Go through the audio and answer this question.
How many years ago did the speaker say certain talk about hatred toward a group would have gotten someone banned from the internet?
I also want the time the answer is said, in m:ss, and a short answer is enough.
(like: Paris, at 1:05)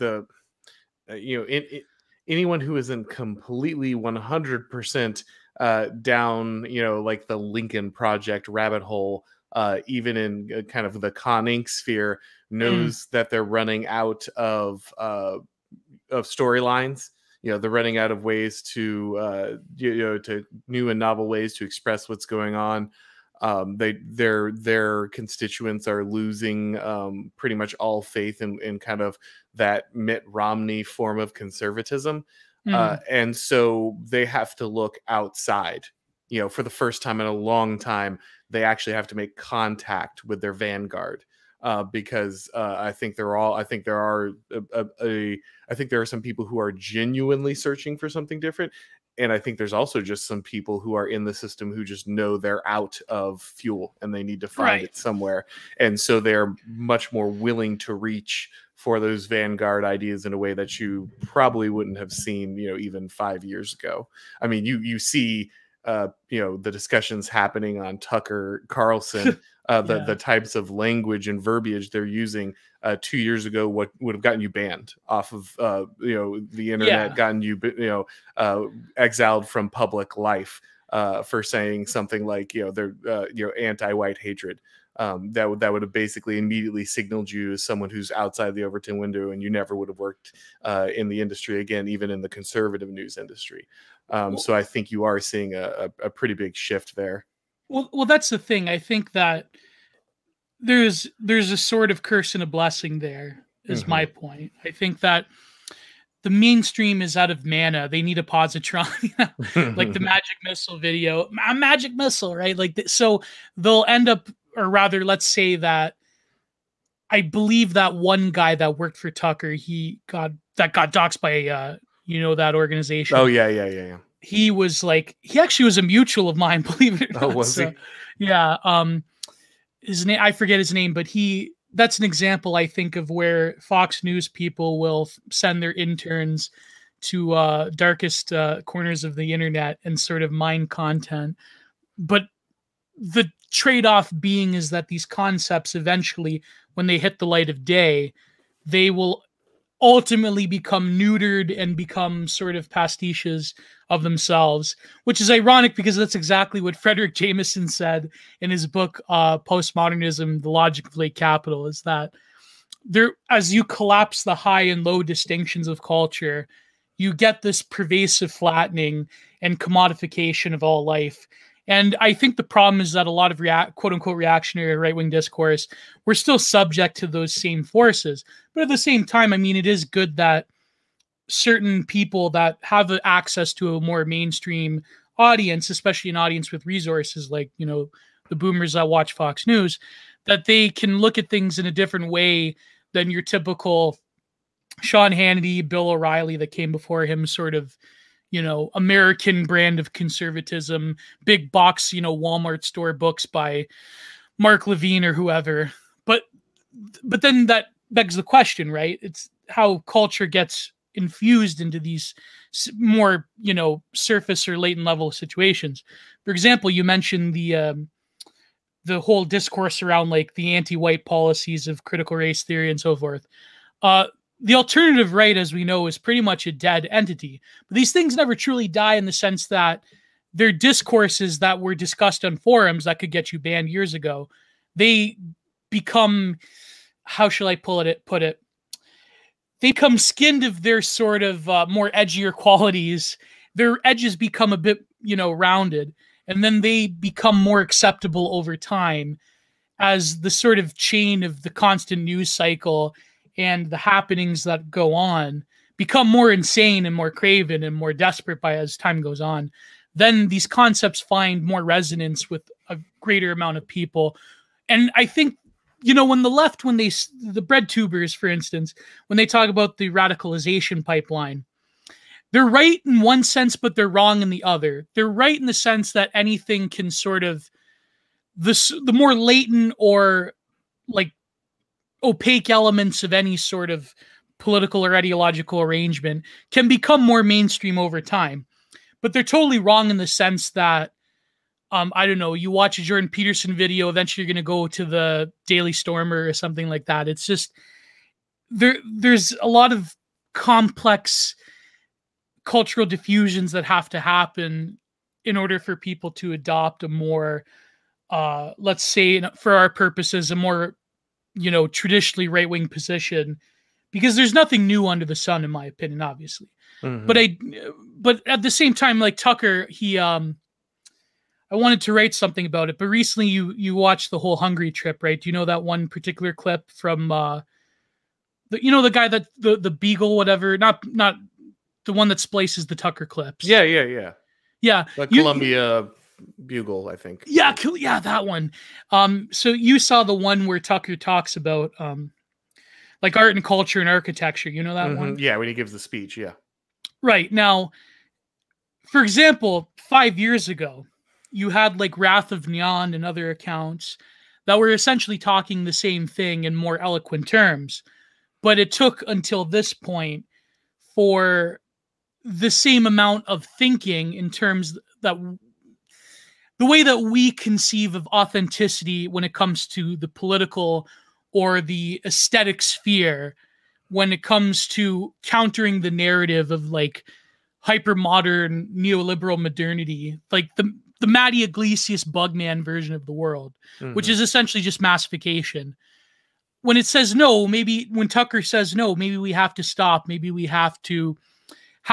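2, at 1:13.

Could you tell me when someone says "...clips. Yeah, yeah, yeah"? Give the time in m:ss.
5:33.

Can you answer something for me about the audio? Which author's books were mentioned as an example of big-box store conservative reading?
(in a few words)
Mark Levine.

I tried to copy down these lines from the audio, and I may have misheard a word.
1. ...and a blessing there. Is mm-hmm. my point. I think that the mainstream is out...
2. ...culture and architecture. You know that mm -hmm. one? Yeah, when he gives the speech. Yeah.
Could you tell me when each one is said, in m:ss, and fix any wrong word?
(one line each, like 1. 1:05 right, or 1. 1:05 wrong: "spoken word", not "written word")
1. 1:42 right
2. 5:43 right.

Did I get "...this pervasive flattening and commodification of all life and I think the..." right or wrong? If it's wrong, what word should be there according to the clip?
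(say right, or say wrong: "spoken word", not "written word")
right.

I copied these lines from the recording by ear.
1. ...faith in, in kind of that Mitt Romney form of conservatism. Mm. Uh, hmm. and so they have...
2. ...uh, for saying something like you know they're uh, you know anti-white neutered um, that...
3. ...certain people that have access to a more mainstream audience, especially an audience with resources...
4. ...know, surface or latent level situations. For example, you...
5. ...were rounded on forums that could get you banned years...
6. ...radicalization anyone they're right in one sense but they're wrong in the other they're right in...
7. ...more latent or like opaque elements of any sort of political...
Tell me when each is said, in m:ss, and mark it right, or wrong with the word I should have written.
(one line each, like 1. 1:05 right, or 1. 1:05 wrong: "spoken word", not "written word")
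1. 0:27 right
2. 1:20 wrong: "hatred", not "neutered"
3. 3:01 right
4. 3:33 right
5. 3:51 wrong: "discussed", not "rounded"
6. 4:29 wrong: "pipeline", not "anyone"
7. 4:38 right.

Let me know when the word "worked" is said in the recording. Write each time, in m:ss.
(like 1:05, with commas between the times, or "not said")
1:29, 1:58.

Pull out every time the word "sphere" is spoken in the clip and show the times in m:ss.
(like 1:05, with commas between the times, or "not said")
0:11, 6:12.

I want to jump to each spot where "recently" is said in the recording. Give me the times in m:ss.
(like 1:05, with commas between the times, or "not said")
5:22.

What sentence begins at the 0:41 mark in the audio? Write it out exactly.
Uh, because uh, I think they're all.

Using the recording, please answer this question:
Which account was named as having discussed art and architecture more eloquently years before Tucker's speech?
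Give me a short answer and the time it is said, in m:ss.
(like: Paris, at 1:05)
Wrath of Gnon, at 5:51.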